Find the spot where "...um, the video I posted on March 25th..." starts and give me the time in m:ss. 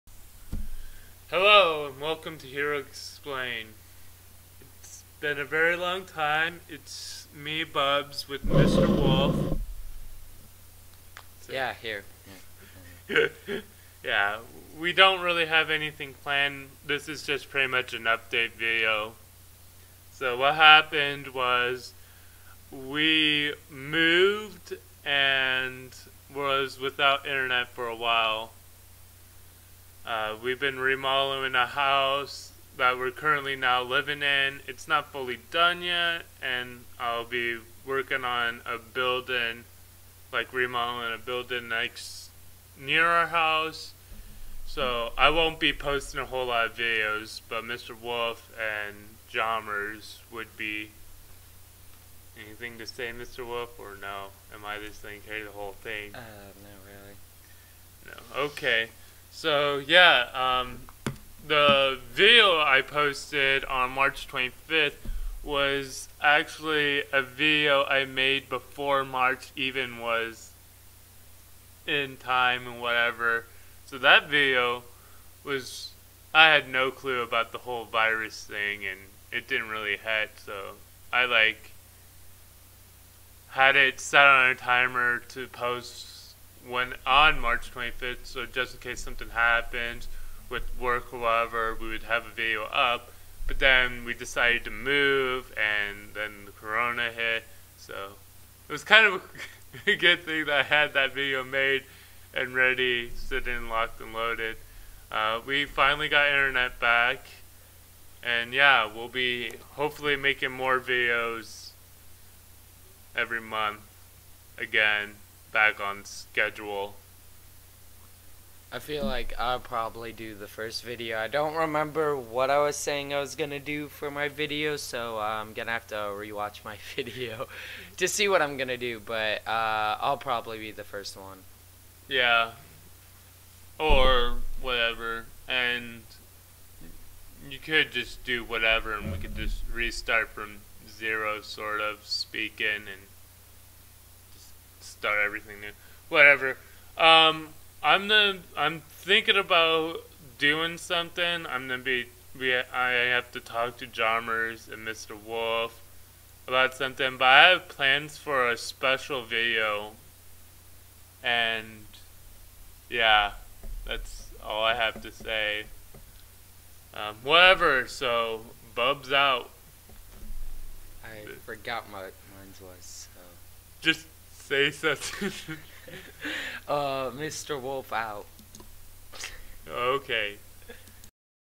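1:00.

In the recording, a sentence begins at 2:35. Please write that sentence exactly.
Wolf about something, but I have plans for a special video.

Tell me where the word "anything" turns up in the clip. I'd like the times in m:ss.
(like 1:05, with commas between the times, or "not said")
0:15, 0:52.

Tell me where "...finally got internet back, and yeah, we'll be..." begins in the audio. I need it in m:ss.
1:45.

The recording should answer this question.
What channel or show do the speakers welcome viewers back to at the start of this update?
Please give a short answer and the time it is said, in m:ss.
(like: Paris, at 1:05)
Heroes Explain, at 0:02.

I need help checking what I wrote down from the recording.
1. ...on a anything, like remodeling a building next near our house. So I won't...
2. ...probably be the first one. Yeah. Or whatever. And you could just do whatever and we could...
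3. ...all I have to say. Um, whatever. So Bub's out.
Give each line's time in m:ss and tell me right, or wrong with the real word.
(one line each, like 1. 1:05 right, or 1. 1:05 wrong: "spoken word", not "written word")
1. 0:38 wrong: "building", not "anything"
2. 2:10 right
3. 2:44 right.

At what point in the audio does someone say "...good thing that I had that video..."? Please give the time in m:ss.
1:39.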